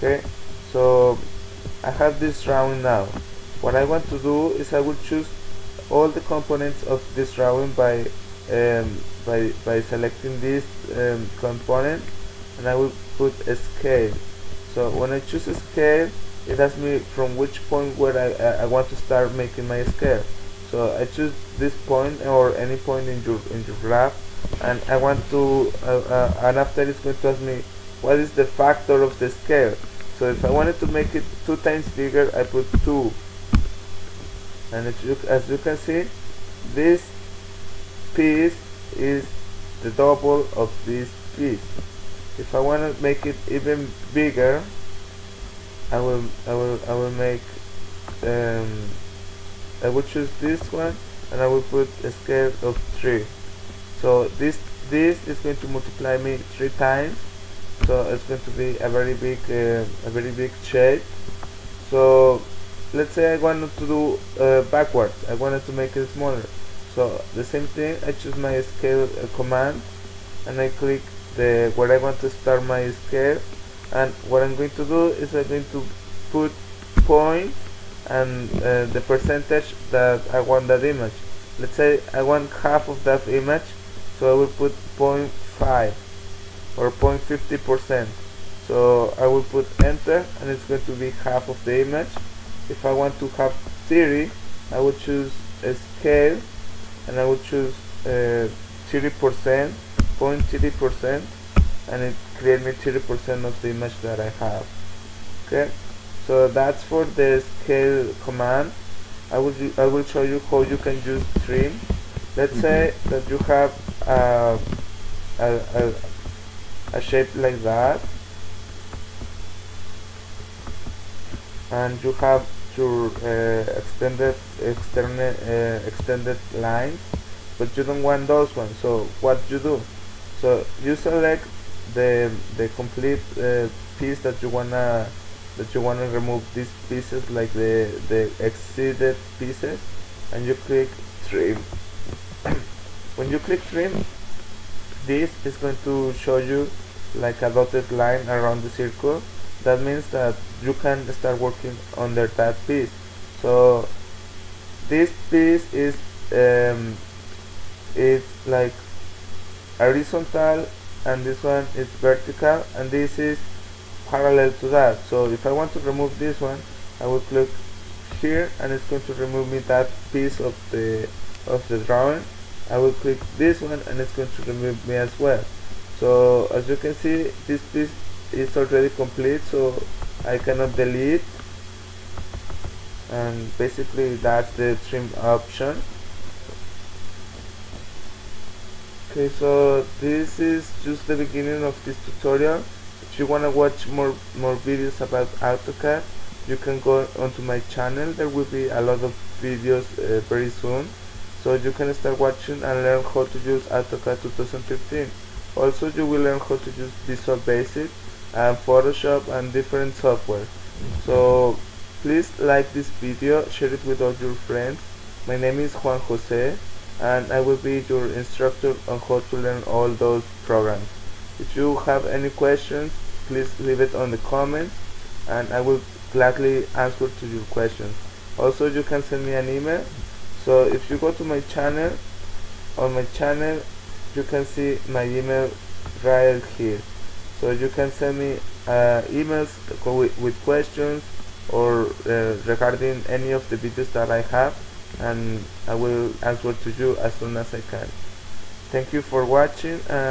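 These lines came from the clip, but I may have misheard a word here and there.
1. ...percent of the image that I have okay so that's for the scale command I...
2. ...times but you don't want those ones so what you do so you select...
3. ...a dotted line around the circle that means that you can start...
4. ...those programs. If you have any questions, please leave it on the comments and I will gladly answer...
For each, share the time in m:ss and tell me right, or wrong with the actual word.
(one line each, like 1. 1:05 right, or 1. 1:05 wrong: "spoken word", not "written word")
1. 1:43 right
2. 2:06 wrong: "lines", not "times"
3. 2:27 right
4. 3:39 right.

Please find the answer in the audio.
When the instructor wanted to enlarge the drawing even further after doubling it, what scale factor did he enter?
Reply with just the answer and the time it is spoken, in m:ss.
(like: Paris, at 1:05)
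3, at 0:53.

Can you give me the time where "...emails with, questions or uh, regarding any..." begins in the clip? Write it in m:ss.
3:59.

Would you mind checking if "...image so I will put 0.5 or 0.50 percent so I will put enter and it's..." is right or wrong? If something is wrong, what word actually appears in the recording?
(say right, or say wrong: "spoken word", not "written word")
right.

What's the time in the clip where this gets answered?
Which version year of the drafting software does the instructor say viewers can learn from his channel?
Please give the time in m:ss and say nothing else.
3:24.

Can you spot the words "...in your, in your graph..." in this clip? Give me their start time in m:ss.
0:23.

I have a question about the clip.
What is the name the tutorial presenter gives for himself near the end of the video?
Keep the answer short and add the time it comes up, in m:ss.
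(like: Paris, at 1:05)
Juan Jose, at 3:35.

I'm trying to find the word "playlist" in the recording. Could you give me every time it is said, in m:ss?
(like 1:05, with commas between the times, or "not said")
not said.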